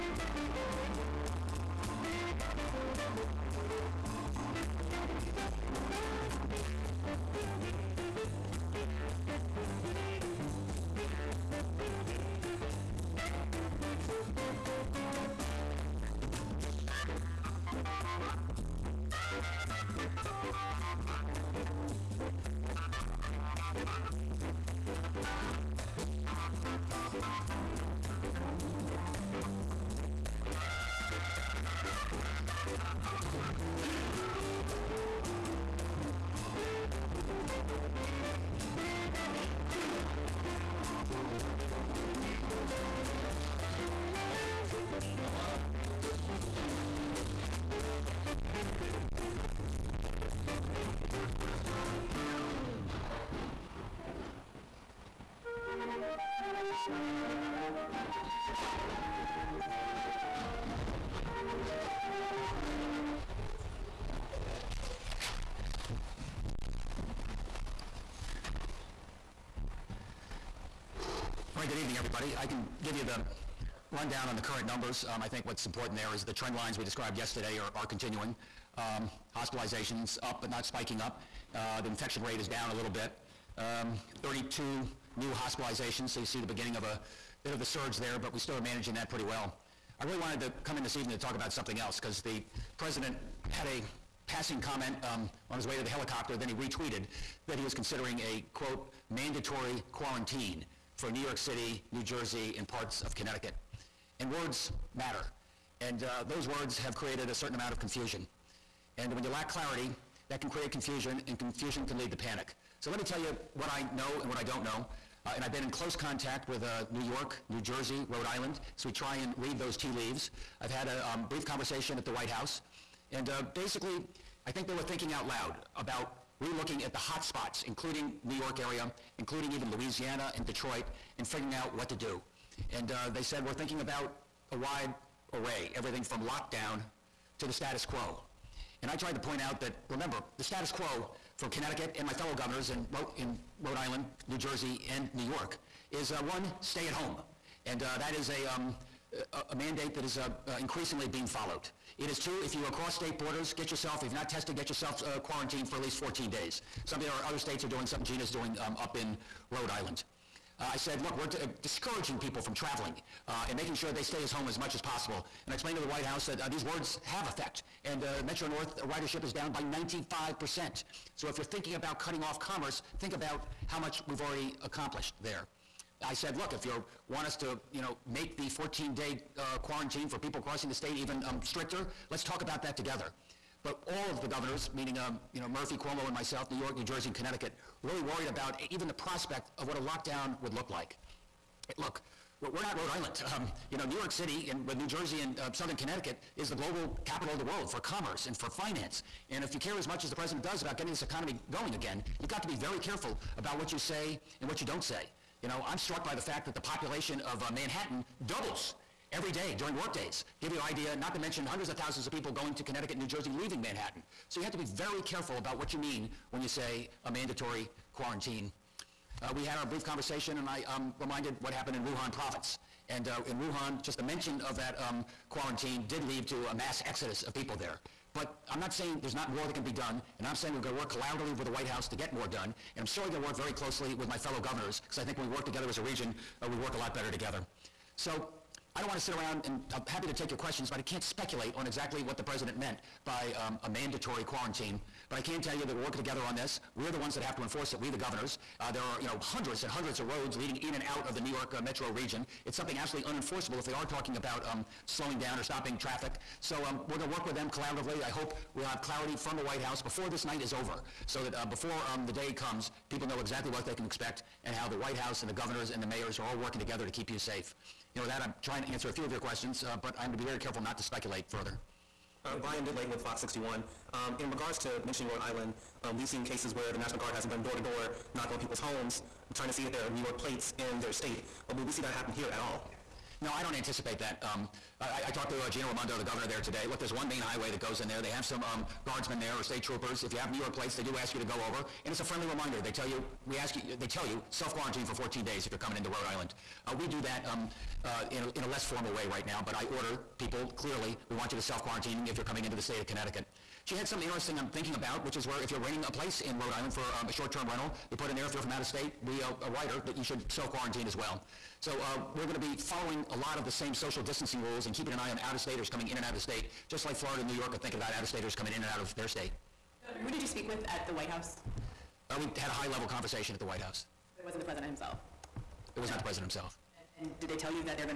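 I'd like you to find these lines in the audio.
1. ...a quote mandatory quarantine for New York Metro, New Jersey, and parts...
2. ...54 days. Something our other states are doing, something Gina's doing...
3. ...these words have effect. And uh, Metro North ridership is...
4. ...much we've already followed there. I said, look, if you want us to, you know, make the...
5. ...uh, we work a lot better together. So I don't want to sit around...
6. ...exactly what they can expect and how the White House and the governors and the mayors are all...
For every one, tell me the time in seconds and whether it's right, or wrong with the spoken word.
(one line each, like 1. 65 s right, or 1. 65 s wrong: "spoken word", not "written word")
1. 98 s wrong: "City", not "Metro"
2. 155 s wrong: "14", not "54"
3. 166 s right
4. 173 s wrong: "accomplished", not "followed"
5. 236 s right
6. 263 s right.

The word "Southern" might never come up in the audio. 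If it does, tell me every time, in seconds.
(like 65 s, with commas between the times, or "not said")
195 s.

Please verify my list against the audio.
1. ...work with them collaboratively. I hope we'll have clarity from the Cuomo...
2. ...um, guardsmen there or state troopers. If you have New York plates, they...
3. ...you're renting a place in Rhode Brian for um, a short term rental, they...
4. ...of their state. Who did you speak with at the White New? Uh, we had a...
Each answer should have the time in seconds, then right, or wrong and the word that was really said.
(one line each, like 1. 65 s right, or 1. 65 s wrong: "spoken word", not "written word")
1. 257 s wrong: "White", not "Cuomo"
2. 288 s right
3. 305 s wrong: "Island", not "Brian"
4. 318 s wrong: "House", not "New".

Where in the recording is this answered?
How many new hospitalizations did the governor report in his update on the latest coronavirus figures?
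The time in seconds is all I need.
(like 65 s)
84 s.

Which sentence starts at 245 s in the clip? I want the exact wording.
But I can tell you that we're working together on this.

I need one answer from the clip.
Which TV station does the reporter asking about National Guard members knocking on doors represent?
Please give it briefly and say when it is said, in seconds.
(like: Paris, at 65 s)
Fox 61, at 273 s.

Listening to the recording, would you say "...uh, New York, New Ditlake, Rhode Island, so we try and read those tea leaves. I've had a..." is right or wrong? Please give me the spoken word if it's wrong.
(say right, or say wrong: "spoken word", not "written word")
wrong: "Jersey", not "Ditlake".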